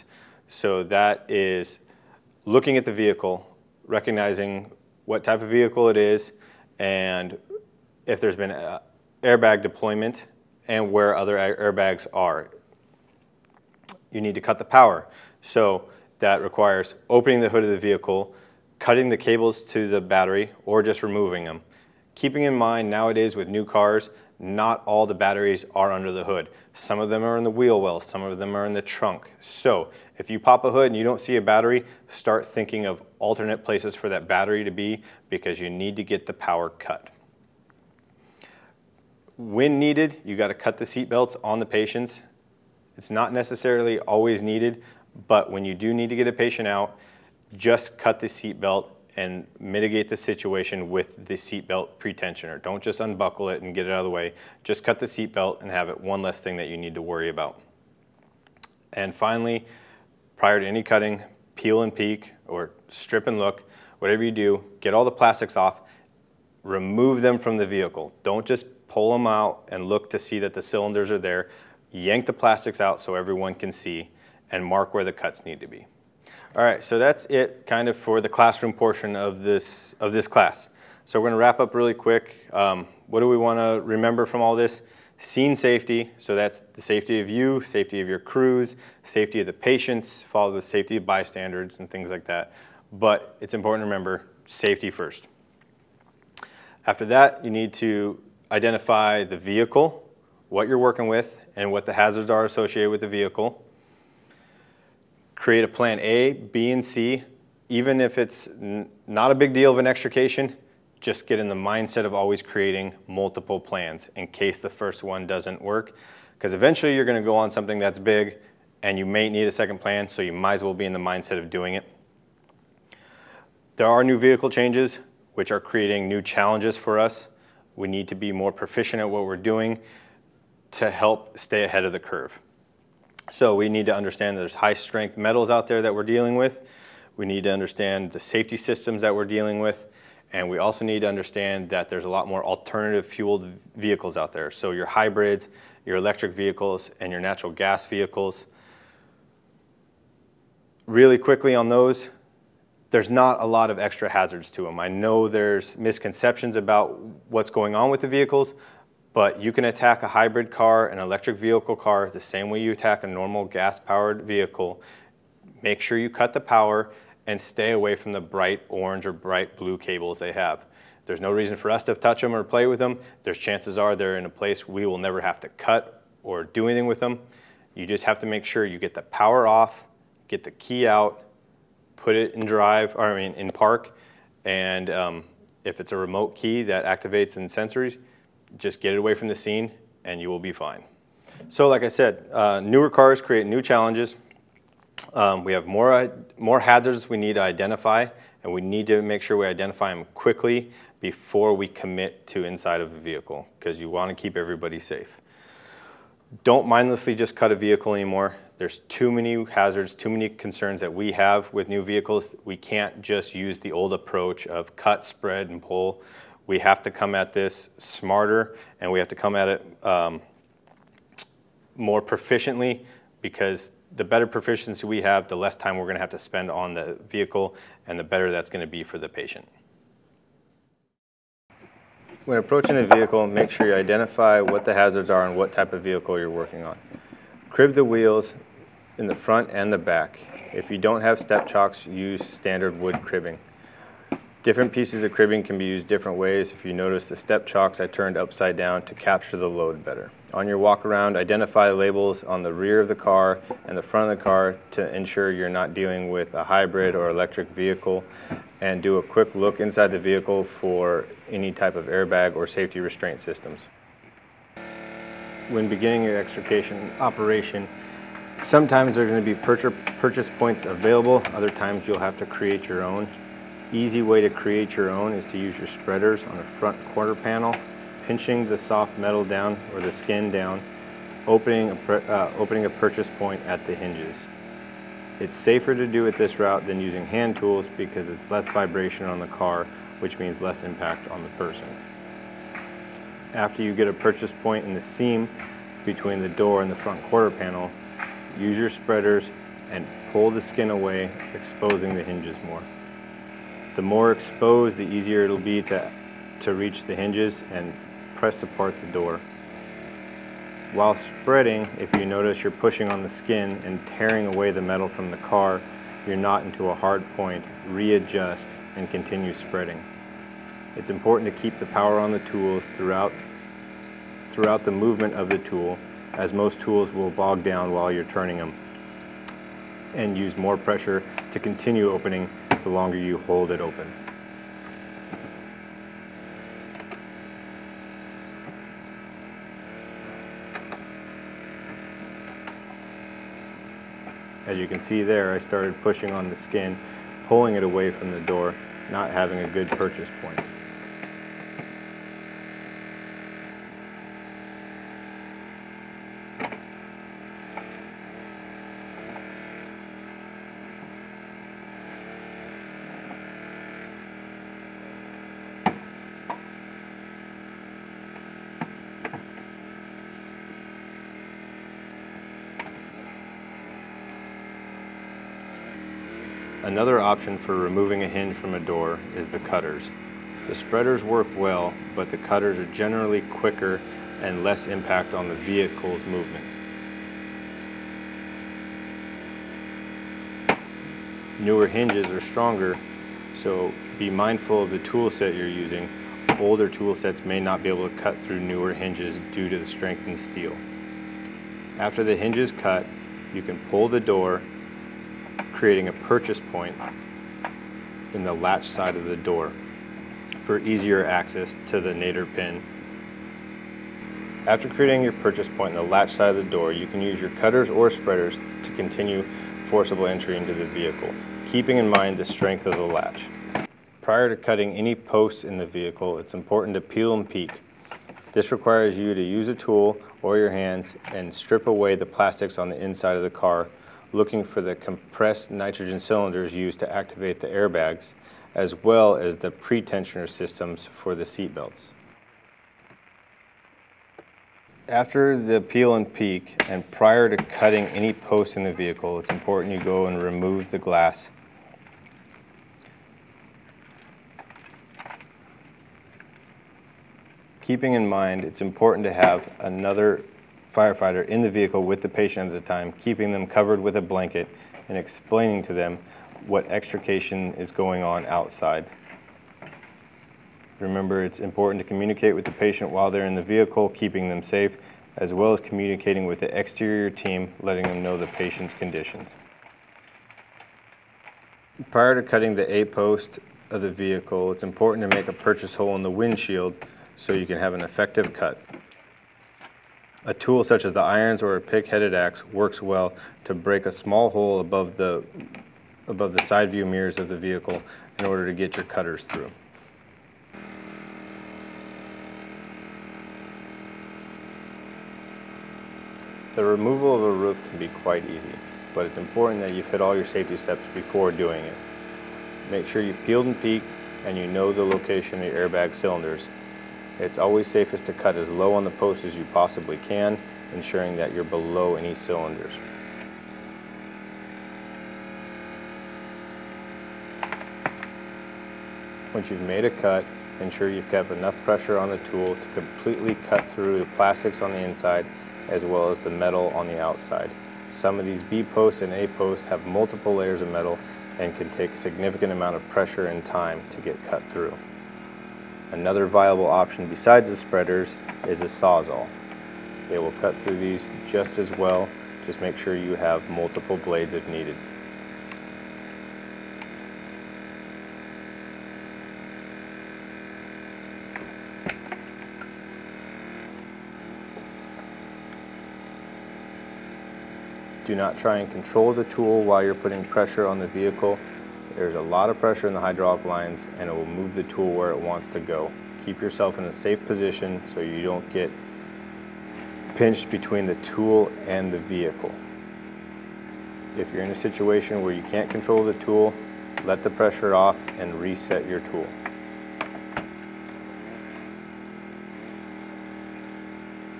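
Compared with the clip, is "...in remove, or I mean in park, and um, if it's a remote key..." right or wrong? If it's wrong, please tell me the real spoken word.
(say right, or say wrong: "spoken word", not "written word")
wrong: "drive", not "remove".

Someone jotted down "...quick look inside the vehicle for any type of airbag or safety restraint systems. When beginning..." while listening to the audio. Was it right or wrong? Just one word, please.
right.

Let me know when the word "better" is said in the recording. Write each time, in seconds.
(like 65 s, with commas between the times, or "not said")
224 s, 228 s, 249 s.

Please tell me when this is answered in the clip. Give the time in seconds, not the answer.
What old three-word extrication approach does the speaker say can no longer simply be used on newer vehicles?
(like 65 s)
214 s.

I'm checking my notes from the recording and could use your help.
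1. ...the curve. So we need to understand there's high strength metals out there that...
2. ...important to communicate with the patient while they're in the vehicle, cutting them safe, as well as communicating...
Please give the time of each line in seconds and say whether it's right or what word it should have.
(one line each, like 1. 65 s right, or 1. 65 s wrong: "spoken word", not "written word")
1. 131 s right
2. 471 s wrong: "keeping", not "cutting".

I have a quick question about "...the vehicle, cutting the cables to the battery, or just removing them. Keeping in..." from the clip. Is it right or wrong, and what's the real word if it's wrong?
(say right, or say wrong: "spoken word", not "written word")
right.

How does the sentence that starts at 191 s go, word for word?
So like I said, uh, newer cars create new challenges.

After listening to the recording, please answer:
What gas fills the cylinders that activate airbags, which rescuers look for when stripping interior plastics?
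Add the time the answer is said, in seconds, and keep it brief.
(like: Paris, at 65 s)
Compressed nitrogen, at 434 s.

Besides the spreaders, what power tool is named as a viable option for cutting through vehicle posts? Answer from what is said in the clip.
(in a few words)
Sawzall.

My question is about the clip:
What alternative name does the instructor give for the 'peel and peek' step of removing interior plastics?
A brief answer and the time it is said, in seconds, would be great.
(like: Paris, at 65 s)
Strip and look, at 62 s.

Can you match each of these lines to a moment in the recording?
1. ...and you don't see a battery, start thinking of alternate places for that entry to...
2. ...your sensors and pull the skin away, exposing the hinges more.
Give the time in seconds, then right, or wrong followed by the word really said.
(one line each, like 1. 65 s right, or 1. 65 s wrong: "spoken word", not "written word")
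1. 30 s wrong: "battery", not "entry"
2. 298 s wrong: "spreaders", not "sensors".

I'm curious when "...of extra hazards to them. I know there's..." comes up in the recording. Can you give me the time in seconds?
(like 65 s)
153 s.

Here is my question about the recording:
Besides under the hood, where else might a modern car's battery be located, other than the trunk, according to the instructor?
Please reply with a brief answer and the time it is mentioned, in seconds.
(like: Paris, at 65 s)
In the wheel well, at 27 s.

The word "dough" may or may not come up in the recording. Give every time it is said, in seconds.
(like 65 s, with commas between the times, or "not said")
not said.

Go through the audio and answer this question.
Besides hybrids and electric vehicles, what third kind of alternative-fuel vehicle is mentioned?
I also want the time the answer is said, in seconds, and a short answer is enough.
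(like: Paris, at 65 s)
Natural gas vehicles, at 147 s.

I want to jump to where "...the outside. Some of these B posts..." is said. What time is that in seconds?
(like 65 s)
536 s.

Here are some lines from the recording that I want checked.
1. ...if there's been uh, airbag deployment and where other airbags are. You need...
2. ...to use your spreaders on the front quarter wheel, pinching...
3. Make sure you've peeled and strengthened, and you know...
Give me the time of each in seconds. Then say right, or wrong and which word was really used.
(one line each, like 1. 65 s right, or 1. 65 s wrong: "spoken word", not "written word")
1. 8 s right
2. 275 s wrong: "panel", not "wheel"
3. 512 s wrong: "peeked", not "strengthened".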